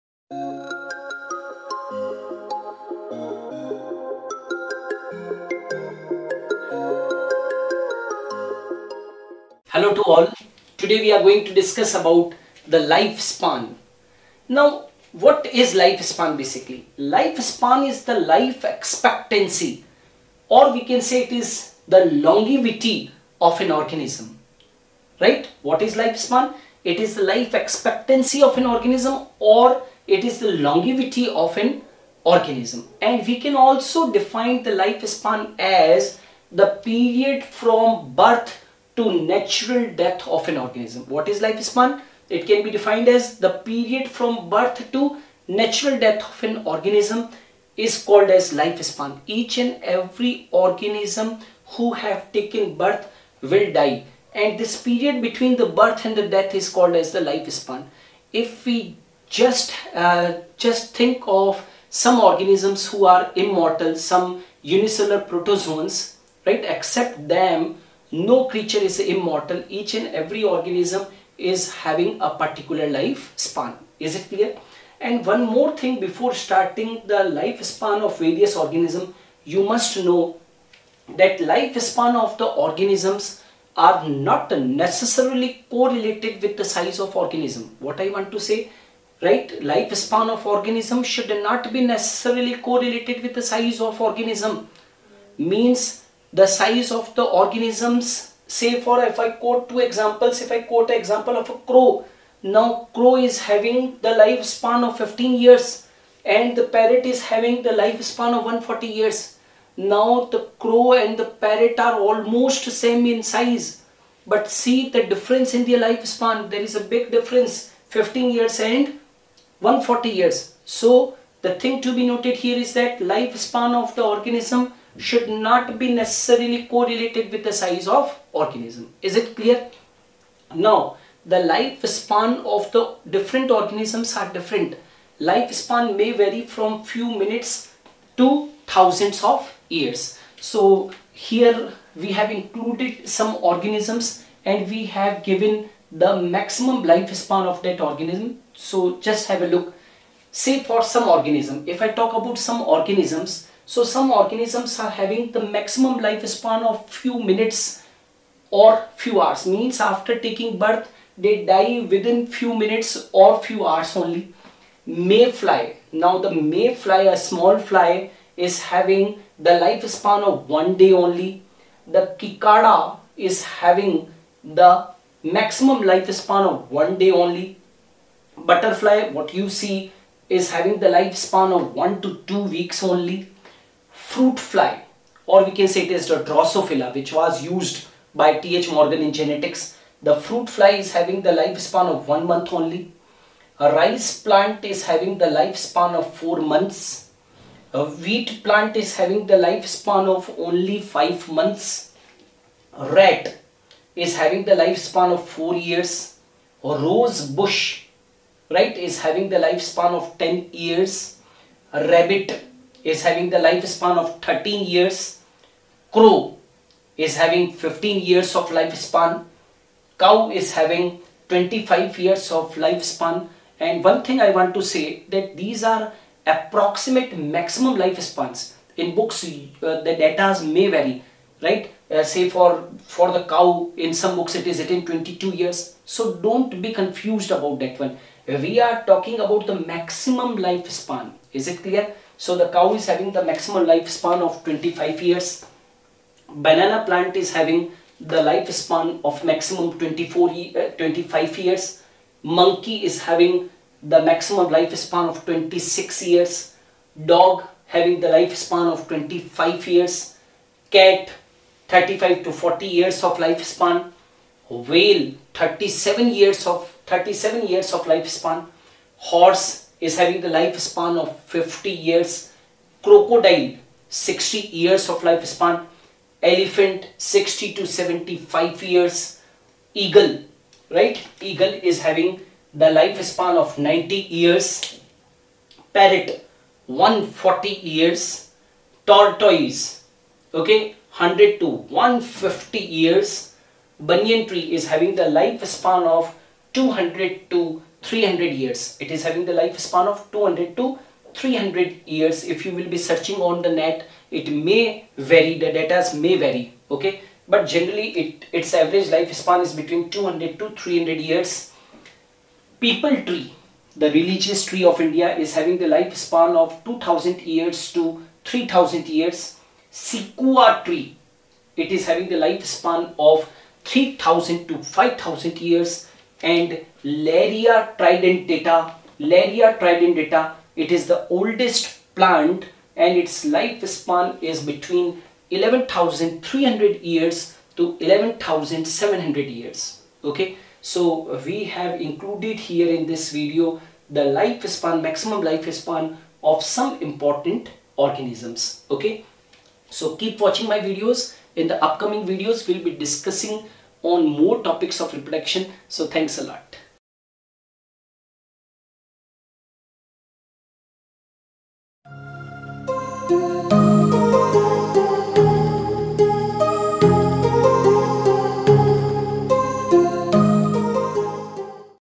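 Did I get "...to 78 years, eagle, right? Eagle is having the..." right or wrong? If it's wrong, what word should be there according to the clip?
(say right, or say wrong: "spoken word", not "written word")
wrong: "75", not "78".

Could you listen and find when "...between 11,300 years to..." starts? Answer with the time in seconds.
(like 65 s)
334 s.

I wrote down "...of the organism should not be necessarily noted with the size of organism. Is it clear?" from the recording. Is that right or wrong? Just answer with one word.
wrong.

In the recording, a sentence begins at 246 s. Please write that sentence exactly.
Banana plant is having the lifespan of maximum 24 uh, 25 years.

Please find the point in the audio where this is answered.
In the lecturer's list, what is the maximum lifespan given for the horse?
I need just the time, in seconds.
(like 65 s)
271 s.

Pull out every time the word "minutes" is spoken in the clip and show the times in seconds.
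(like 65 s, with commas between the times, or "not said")
137 s, 157 s, 162 s.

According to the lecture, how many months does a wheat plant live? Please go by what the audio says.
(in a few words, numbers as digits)
5 months.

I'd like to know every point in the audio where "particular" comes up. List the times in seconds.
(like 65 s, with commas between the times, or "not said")
72 s.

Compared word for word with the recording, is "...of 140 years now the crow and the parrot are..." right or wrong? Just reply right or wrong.
right.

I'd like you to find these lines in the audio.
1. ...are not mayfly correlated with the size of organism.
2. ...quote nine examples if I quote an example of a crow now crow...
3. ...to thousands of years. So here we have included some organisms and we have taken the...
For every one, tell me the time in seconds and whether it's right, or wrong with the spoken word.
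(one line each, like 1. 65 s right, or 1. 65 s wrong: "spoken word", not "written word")
1. 83 s wrong: "necessarily", not "mayfly"
2. 99 s wrong: "two", not "nine"
3. 138 s wrong: "given", not "taken".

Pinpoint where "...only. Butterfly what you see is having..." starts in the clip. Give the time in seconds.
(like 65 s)
177 s.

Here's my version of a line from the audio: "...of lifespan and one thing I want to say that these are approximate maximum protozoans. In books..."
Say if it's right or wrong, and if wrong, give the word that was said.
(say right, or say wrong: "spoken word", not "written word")
wrong: "lifespans", not "protozoans".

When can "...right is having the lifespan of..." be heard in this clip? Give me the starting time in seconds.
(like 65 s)
208 s.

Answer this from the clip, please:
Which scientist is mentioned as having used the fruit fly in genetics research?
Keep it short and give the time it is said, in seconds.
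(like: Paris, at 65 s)
T.H. Morgan, at 188 s.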